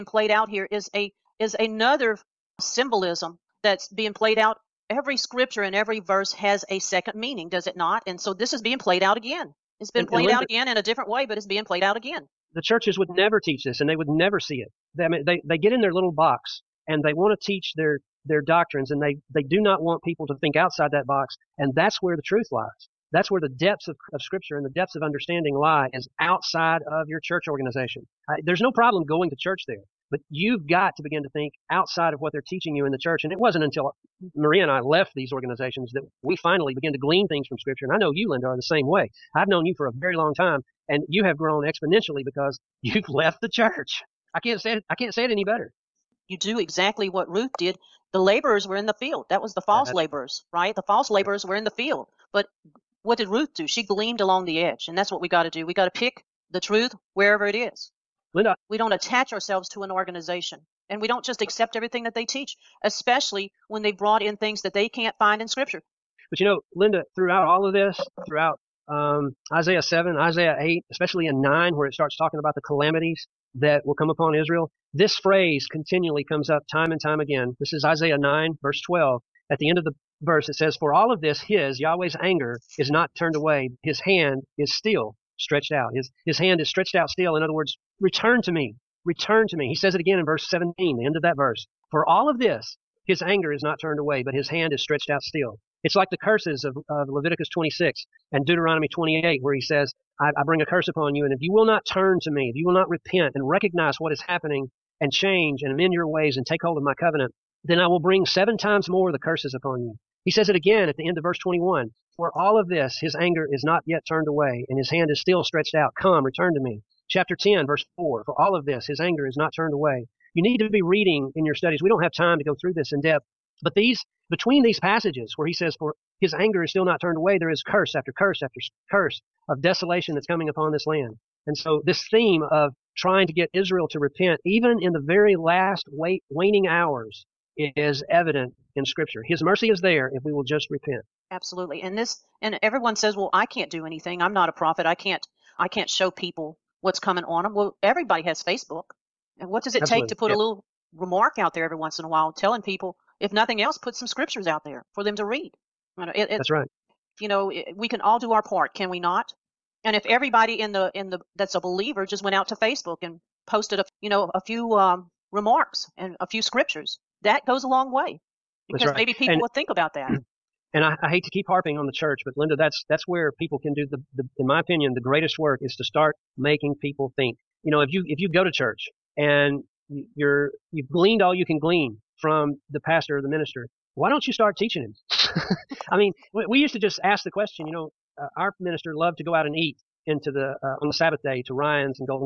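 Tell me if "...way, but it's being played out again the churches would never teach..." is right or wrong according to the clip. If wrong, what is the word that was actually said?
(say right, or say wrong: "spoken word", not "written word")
right.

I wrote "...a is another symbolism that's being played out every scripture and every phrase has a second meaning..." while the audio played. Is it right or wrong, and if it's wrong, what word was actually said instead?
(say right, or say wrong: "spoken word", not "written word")
wrong: "verse", not "phrase".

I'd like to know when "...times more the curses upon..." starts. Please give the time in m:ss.
1:48.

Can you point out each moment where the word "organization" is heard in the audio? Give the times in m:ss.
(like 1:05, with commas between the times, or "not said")
0:27, 0:35, 0:59.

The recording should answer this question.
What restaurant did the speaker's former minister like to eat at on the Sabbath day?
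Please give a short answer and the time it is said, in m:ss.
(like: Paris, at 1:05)
Ryan's, at 3:11.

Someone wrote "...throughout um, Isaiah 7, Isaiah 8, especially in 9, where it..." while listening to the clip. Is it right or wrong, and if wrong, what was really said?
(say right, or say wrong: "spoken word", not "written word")
right.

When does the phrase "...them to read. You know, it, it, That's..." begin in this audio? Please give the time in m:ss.
2:35.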